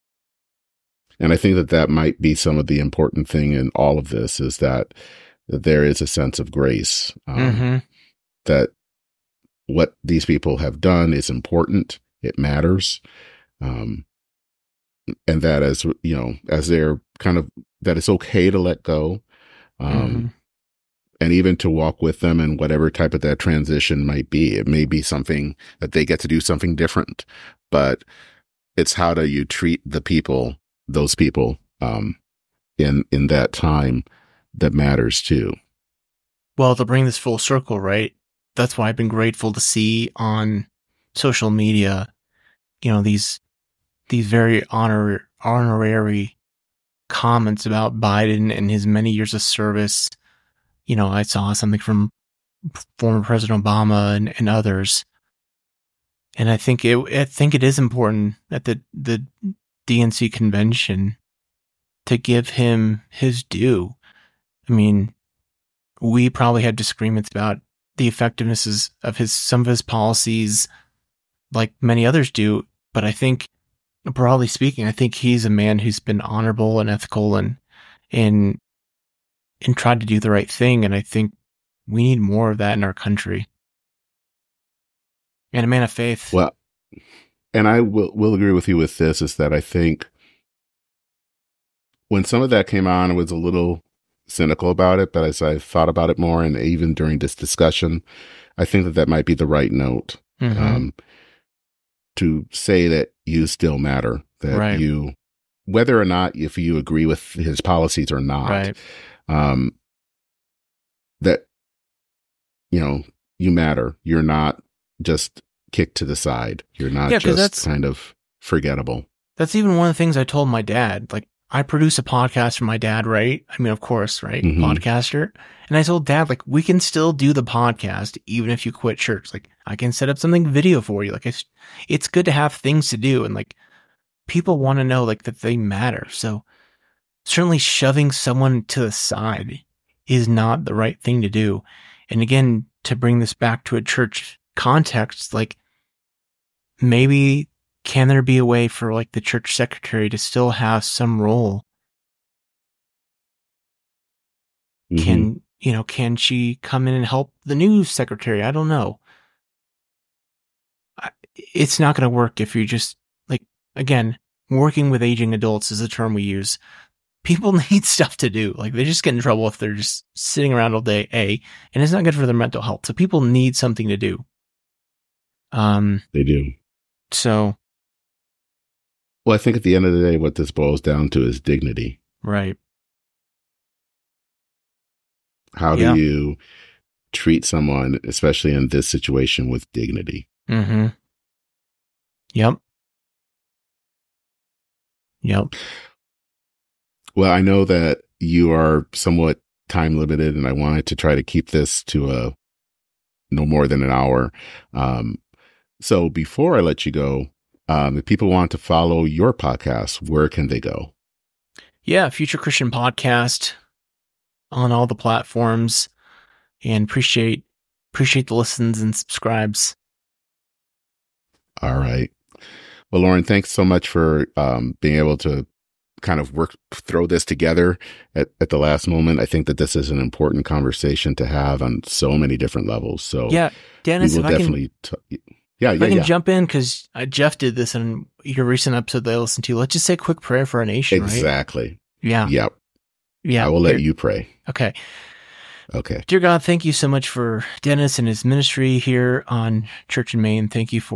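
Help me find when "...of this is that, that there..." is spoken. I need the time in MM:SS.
00:03.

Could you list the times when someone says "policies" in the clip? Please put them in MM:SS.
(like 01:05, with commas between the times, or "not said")
01:09, 01:47.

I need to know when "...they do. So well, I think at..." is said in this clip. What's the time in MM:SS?
02:56.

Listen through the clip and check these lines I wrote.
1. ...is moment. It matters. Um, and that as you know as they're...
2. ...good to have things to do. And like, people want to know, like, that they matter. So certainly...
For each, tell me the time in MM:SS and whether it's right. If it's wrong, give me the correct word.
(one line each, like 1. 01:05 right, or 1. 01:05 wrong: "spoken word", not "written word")
1. 00:11 wrong: "important", not "moment"
2. 02:12 right.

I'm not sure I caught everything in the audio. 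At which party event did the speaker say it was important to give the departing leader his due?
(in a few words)
DNC convention.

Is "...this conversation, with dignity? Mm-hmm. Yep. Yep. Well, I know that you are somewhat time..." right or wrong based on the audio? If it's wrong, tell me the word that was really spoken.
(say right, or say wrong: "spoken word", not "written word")
wrong: "situation", not "conversation".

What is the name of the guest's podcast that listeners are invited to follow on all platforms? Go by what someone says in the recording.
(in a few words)
Future Christian Podcast.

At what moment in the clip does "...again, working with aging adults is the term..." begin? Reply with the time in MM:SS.
02:43.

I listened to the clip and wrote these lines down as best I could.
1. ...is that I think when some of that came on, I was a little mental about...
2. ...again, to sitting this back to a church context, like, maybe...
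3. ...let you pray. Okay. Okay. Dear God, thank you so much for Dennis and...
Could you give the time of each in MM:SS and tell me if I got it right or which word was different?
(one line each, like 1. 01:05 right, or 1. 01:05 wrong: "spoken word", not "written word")
1. 01:29 wrong: "cynical", not "mental"
2. 02:22 wrong: "bring", not "sitting"
3. 04:03 right.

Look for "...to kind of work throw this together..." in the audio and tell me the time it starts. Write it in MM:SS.
03:45.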